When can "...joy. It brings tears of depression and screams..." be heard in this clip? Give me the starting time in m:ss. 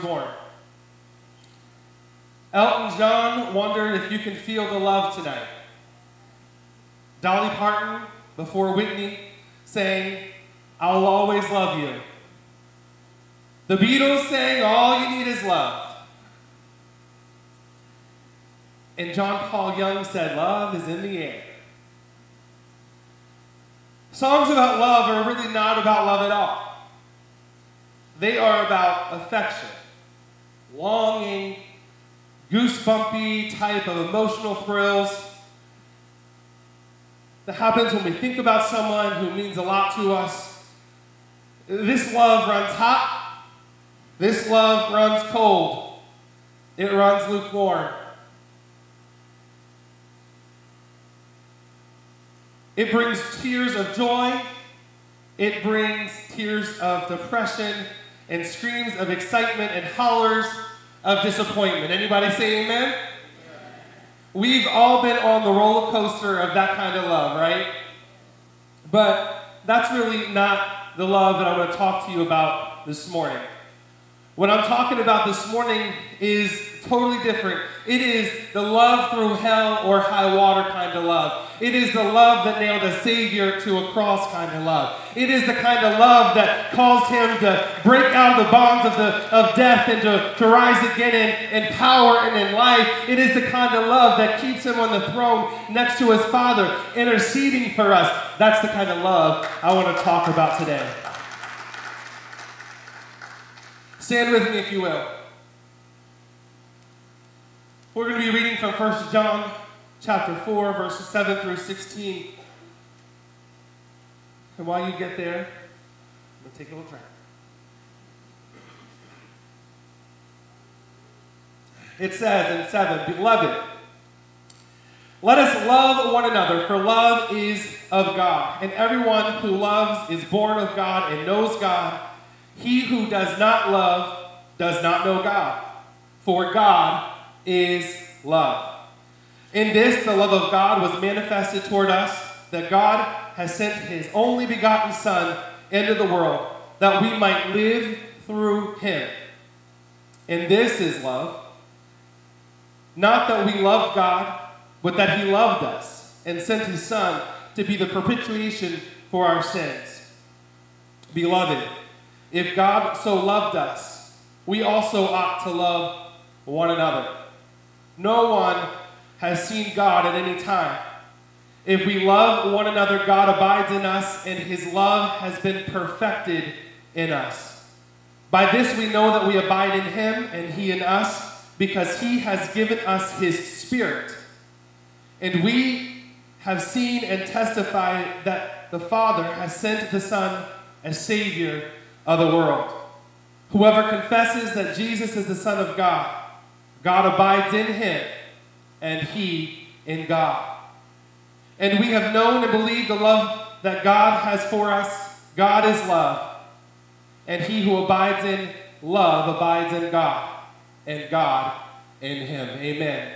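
0:53.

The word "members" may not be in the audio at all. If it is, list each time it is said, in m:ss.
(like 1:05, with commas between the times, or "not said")
not said.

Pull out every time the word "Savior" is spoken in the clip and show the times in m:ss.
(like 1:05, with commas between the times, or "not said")
1:22, 3:11.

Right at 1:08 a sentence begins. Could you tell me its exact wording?
But that's really not the love that I'm going to talk to you about this morning.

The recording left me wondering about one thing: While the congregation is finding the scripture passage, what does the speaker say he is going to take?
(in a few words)
a little drink.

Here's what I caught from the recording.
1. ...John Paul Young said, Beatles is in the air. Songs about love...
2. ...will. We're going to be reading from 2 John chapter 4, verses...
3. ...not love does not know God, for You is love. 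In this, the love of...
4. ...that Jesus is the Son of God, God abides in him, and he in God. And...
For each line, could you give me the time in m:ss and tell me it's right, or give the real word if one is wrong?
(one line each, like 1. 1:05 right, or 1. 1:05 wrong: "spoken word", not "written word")
1. 0:19 wrong: "Love", not "Beatles"
2. 1:44 wrong: "1", not "2"
3. 2:13 wrong: "God", not "You"
4. 3:14 right.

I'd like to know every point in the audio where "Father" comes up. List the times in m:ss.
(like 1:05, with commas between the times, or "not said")
1:36, 3:08.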